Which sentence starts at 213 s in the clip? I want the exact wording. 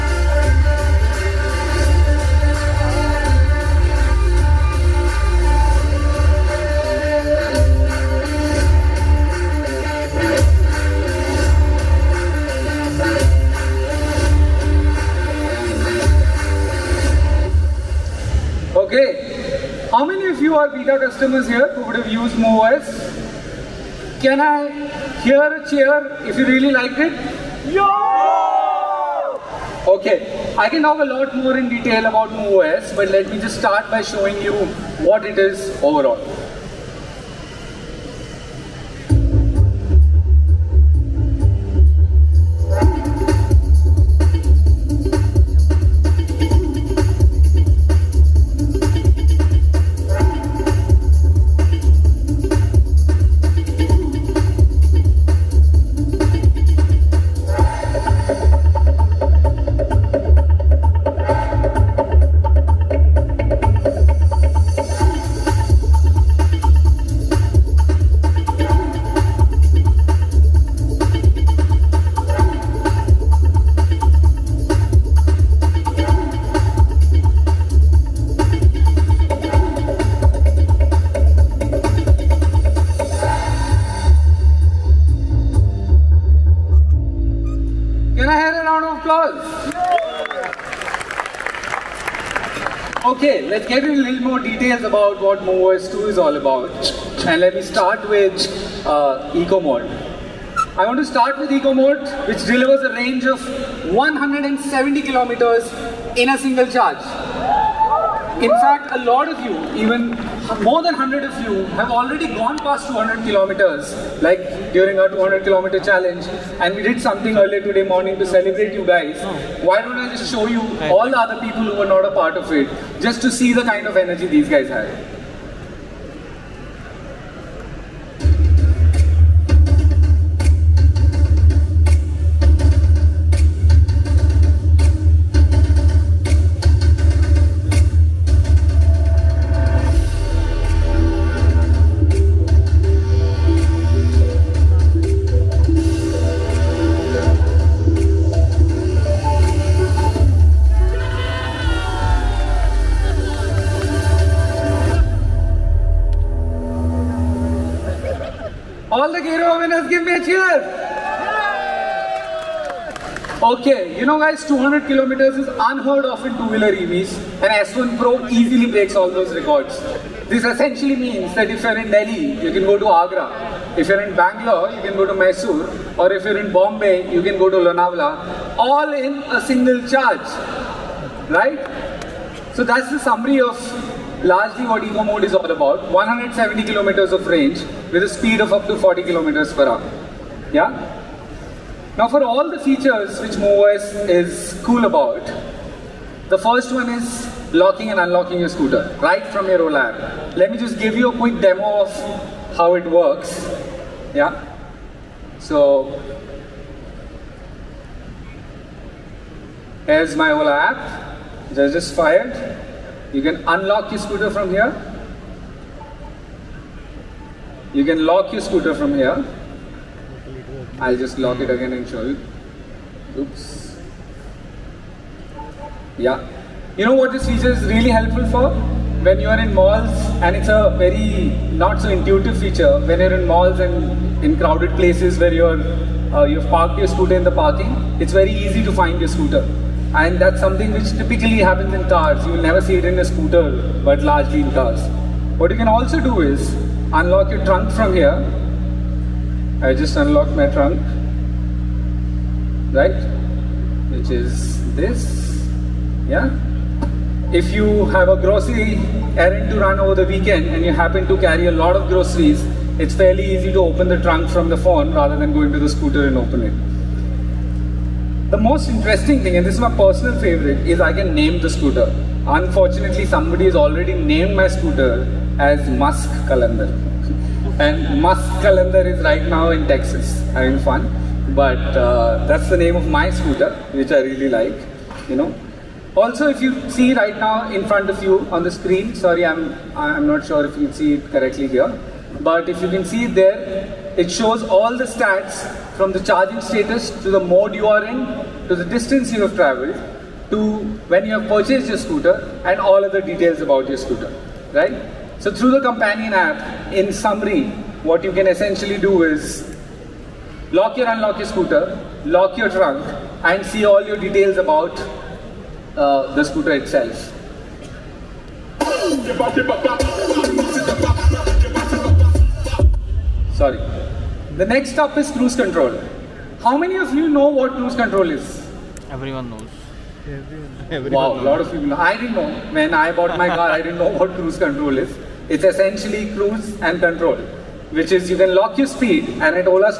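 You can unlock your scooter from here.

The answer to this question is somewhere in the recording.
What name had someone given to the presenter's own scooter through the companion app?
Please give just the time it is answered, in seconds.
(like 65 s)
275 s.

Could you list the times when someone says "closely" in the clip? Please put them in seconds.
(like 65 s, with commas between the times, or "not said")
not said.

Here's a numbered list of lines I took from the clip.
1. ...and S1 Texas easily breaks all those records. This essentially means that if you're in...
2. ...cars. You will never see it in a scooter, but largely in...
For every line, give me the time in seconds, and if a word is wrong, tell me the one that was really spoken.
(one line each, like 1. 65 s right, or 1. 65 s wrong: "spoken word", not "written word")
1. 167 s wrong: "Pro", not "Texas"
2. 241 s right.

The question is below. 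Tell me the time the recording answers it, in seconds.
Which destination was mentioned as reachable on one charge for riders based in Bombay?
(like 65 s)
177 s.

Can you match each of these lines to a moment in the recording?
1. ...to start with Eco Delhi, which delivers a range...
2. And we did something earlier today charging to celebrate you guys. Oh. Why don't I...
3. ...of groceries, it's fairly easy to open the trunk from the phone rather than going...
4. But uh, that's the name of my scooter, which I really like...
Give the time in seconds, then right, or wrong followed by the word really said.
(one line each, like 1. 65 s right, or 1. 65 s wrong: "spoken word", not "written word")
1. 100 s wrong: "Mode", not "Delhi"
2. 116 s wrong: "morning", not "charging"
3. 261 s right
4. 281 s right.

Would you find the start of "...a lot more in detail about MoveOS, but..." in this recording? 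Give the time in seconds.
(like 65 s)
30 s.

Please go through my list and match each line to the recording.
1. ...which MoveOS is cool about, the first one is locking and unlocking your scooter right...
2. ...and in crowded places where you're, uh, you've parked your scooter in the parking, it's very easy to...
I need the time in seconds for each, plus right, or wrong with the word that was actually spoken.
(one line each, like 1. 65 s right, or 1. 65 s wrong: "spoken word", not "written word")
1. 193 s right
2. 233 s right.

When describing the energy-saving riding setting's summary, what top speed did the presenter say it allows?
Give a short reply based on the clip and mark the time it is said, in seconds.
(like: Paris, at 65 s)
40 kilometers per hour, at 188 s.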